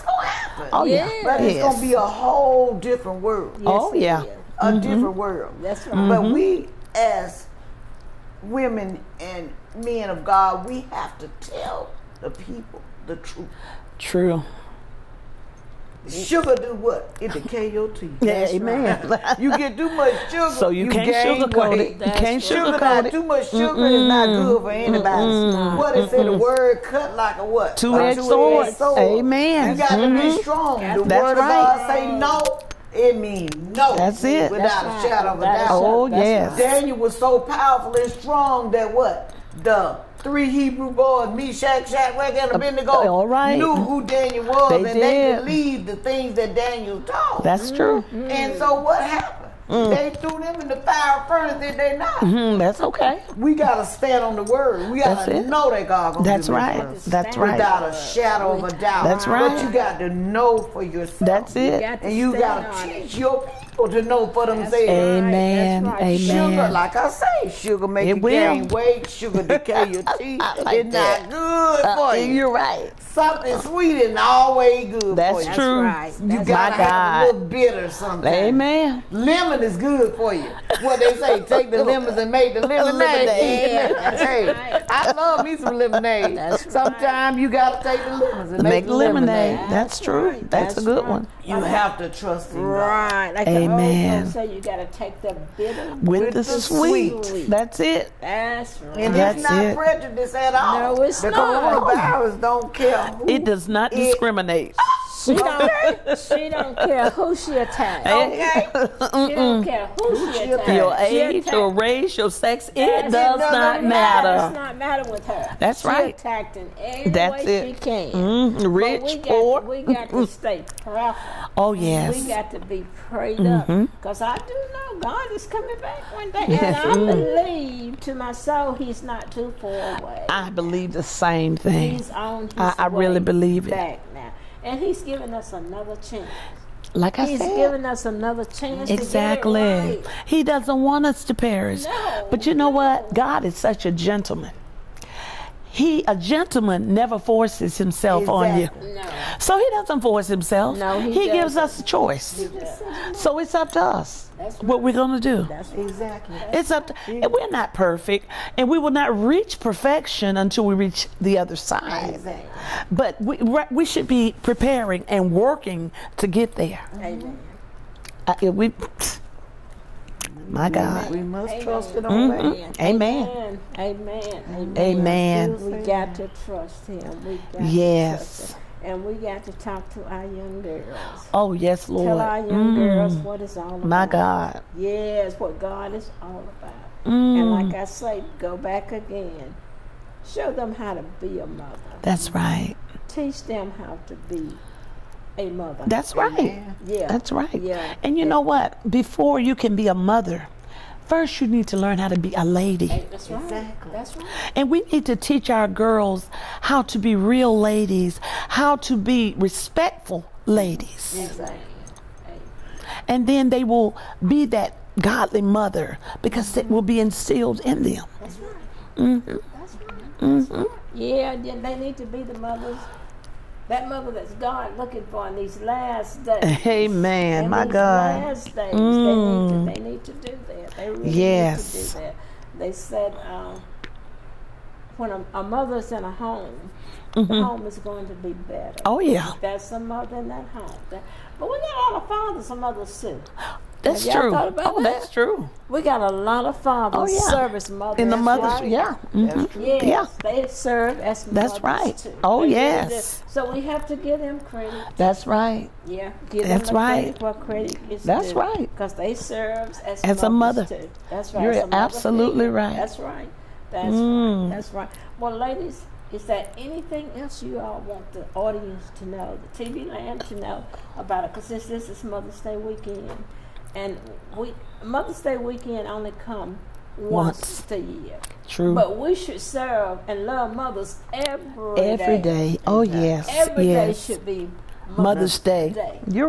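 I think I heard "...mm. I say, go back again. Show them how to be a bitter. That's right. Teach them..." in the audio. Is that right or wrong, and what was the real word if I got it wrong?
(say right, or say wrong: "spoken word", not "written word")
wrong: "mother", not "bitter".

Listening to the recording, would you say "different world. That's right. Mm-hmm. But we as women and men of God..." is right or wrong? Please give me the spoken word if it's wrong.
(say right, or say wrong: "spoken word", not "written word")
right.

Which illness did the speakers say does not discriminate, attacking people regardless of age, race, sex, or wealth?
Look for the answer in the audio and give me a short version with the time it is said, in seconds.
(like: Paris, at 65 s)
coronavirus, at 101 s.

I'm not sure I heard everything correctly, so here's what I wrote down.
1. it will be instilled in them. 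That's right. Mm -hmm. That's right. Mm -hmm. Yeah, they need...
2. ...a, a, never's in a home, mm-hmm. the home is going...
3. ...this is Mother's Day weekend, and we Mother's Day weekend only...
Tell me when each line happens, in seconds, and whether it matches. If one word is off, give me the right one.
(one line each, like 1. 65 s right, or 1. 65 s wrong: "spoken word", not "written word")
1. 216 s right
2. 235 s wrong: "mother", not "never"
3. 271 s right.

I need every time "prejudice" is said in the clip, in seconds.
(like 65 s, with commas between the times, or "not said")
99 s.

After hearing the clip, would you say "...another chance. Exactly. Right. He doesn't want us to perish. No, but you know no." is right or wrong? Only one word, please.
right.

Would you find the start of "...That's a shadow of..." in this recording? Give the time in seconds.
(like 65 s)
34 s.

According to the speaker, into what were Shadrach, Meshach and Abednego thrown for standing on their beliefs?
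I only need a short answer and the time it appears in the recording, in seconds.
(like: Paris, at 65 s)
fire furnace, at 50 s.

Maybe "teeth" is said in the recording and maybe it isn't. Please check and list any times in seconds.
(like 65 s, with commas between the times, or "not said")
17 s, 70 s.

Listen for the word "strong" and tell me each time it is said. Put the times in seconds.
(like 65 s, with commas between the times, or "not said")
30 s, 38 s.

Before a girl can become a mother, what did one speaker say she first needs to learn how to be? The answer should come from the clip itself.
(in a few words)
a lady.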